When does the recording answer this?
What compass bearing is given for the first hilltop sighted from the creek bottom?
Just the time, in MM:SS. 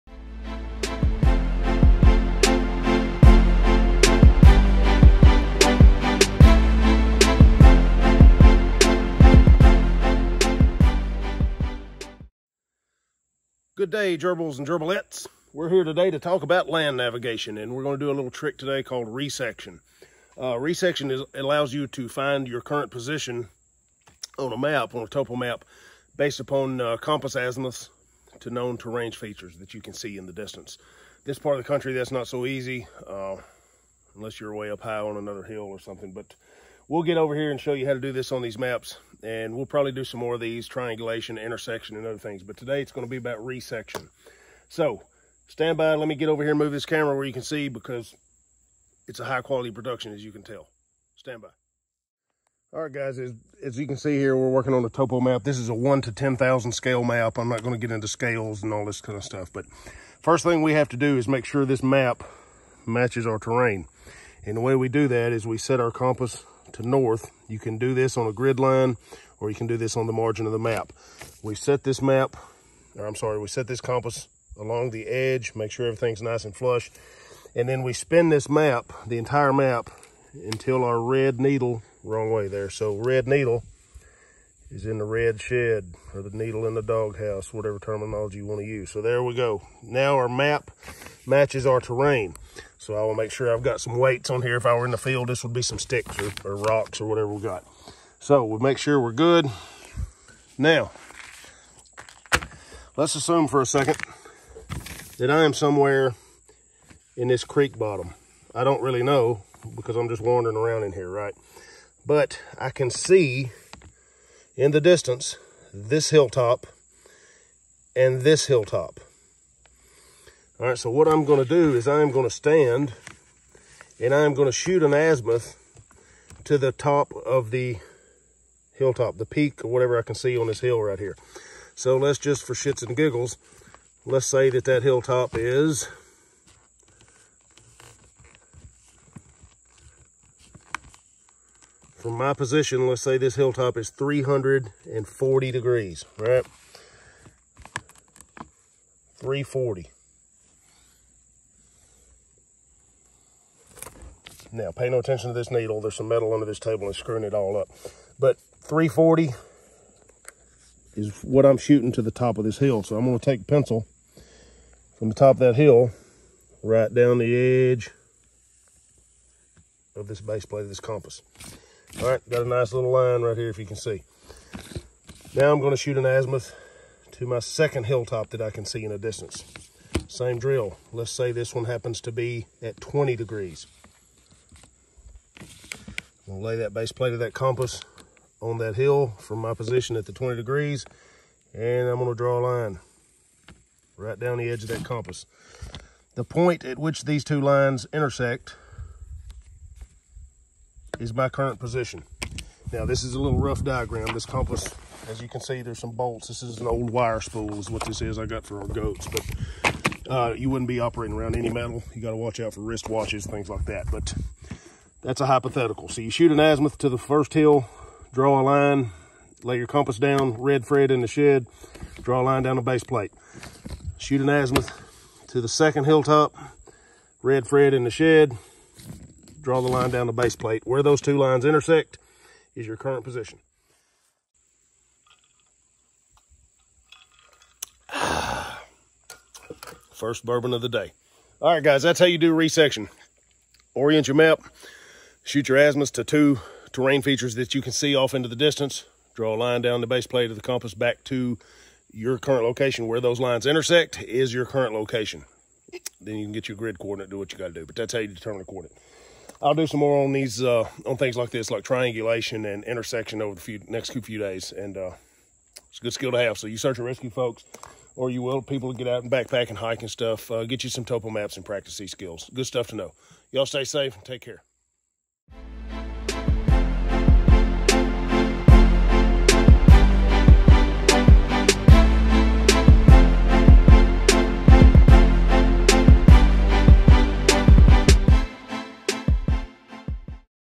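02:23.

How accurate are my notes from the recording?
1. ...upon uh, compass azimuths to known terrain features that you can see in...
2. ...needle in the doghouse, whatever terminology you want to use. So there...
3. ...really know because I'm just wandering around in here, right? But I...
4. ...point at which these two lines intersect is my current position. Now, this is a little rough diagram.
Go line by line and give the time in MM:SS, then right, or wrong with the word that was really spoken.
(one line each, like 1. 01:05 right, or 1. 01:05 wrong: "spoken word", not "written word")
1. 00:26 right
2. 01:26 right
3. 01:48 right
4. 03:16 right.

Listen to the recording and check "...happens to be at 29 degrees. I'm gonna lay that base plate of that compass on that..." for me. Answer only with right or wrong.
wrong.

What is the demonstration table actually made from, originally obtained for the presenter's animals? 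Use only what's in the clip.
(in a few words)
old wire spool.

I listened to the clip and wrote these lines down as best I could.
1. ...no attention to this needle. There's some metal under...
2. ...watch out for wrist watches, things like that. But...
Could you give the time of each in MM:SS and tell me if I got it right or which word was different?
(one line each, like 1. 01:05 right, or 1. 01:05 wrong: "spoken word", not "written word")
1. 02:34 right
2. 03:32 right.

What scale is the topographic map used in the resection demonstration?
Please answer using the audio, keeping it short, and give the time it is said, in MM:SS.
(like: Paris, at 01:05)
1 to 10,000, at 00:55.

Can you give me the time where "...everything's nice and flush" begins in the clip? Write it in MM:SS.
01:15.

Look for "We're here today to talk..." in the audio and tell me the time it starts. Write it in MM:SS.
00:15.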